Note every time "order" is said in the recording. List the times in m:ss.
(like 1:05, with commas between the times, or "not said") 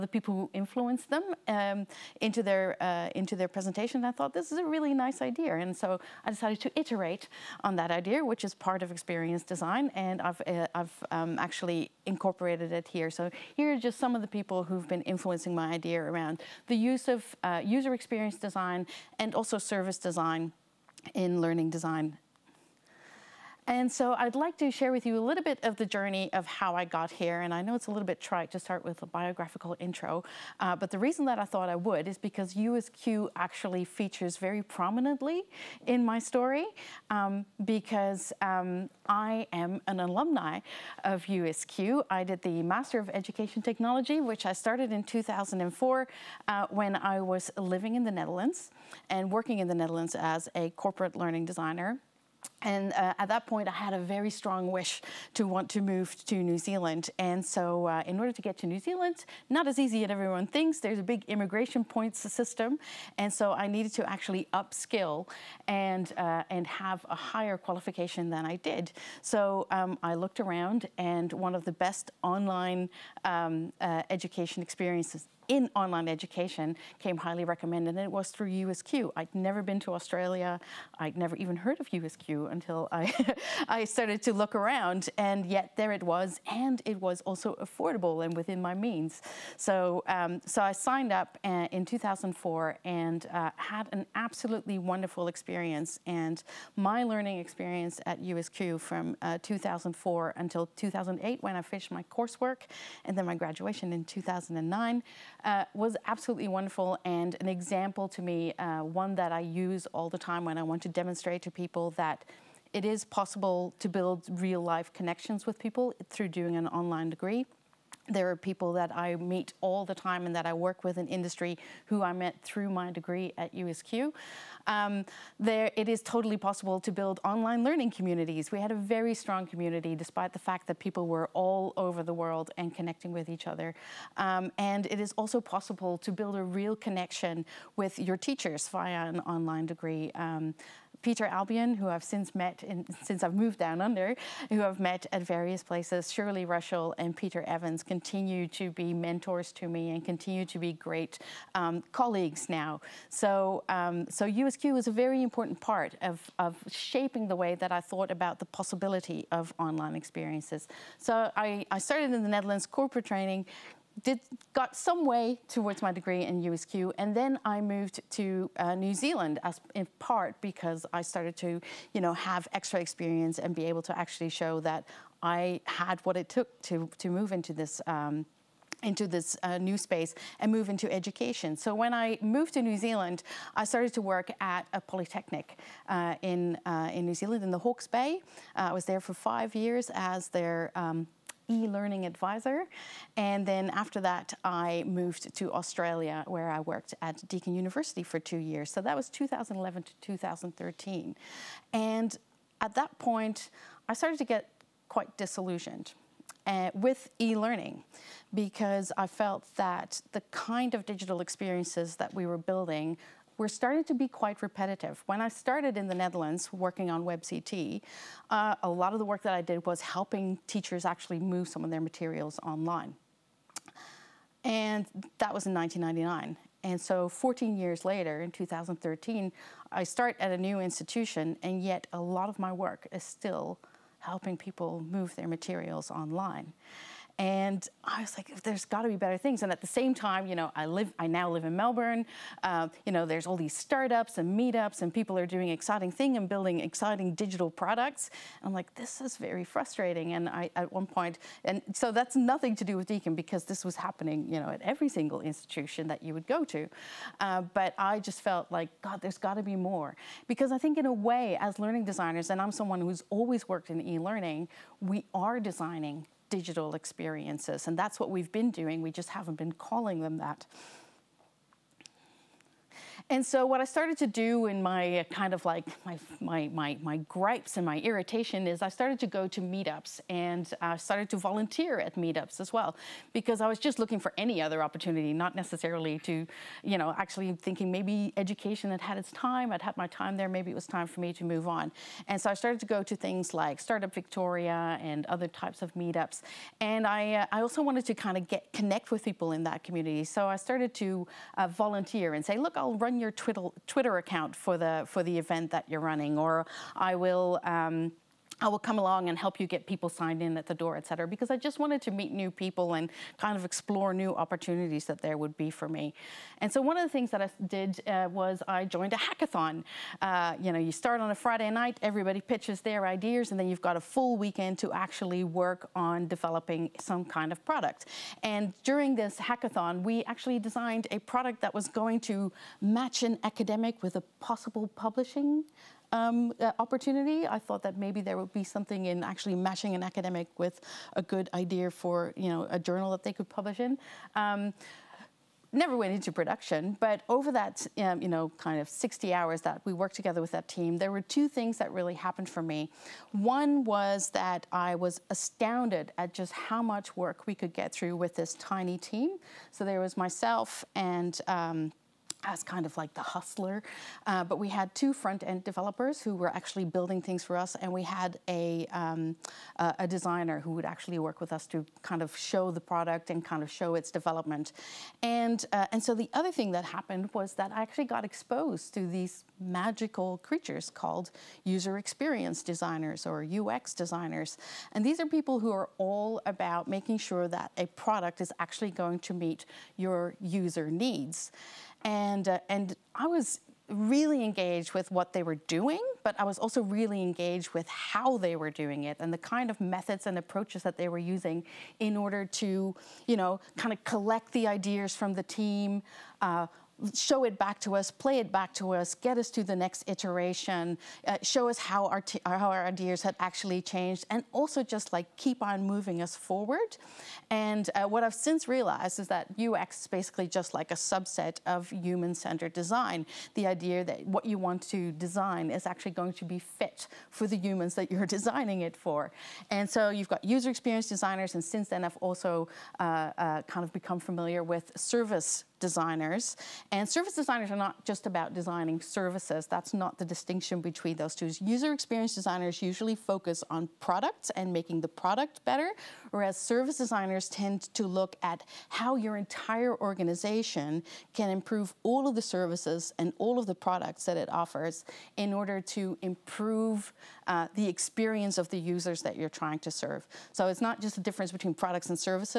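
0:58, 6:41, 7:35.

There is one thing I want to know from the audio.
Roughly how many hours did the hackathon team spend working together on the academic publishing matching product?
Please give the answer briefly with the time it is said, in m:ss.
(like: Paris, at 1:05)
60, at 5:48.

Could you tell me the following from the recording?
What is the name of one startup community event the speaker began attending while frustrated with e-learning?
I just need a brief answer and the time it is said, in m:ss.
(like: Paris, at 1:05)
Startup Victoria, at 4:53.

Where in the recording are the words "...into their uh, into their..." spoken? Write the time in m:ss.
0:02.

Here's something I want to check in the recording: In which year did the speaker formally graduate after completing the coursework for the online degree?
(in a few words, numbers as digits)
2009.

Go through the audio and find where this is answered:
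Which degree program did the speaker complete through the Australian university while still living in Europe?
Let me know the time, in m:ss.
0:42.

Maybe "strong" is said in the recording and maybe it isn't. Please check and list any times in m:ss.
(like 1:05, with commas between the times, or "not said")
0:54, 2:09.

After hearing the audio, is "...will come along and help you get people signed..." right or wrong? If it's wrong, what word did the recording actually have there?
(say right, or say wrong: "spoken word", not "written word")
right.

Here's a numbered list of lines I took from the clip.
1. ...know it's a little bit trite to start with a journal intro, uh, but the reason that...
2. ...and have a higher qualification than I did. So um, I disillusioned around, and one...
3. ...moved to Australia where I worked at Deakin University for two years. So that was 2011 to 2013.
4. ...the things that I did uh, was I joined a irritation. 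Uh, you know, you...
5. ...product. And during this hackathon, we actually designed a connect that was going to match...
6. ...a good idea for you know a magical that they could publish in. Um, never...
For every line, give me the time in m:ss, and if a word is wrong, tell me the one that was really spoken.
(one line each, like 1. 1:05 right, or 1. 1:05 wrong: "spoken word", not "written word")
1. 0:27 wrong: "biographical", not "journal"
2. 1:06 wrong: "looked", not "disillusioned"
3. 3:14 right
4. 5:16 wrong: "hackathon", not "irritation"
5. 5:27 wrong: "product", not "connect"
6. 5:40 wrong: "journal", not "magical".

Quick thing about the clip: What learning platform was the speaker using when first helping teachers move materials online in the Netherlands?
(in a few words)
WebCT.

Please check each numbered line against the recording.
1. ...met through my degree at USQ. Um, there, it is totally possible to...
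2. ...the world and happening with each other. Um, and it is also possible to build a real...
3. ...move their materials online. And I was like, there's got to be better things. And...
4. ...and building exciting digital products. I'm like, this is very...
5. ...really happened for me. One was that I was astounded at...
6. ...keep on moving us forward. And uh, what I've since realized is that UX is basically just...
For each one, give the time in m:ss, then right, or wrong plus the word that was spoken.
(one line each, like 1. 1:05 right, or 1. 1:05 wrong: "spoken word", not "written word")
1. 2:02 right
2. 2:12 wrong: "connecting", not "happening"
3. 3:54 right
4. 4:06 right
5. 5:51 right
6. 6:55 right.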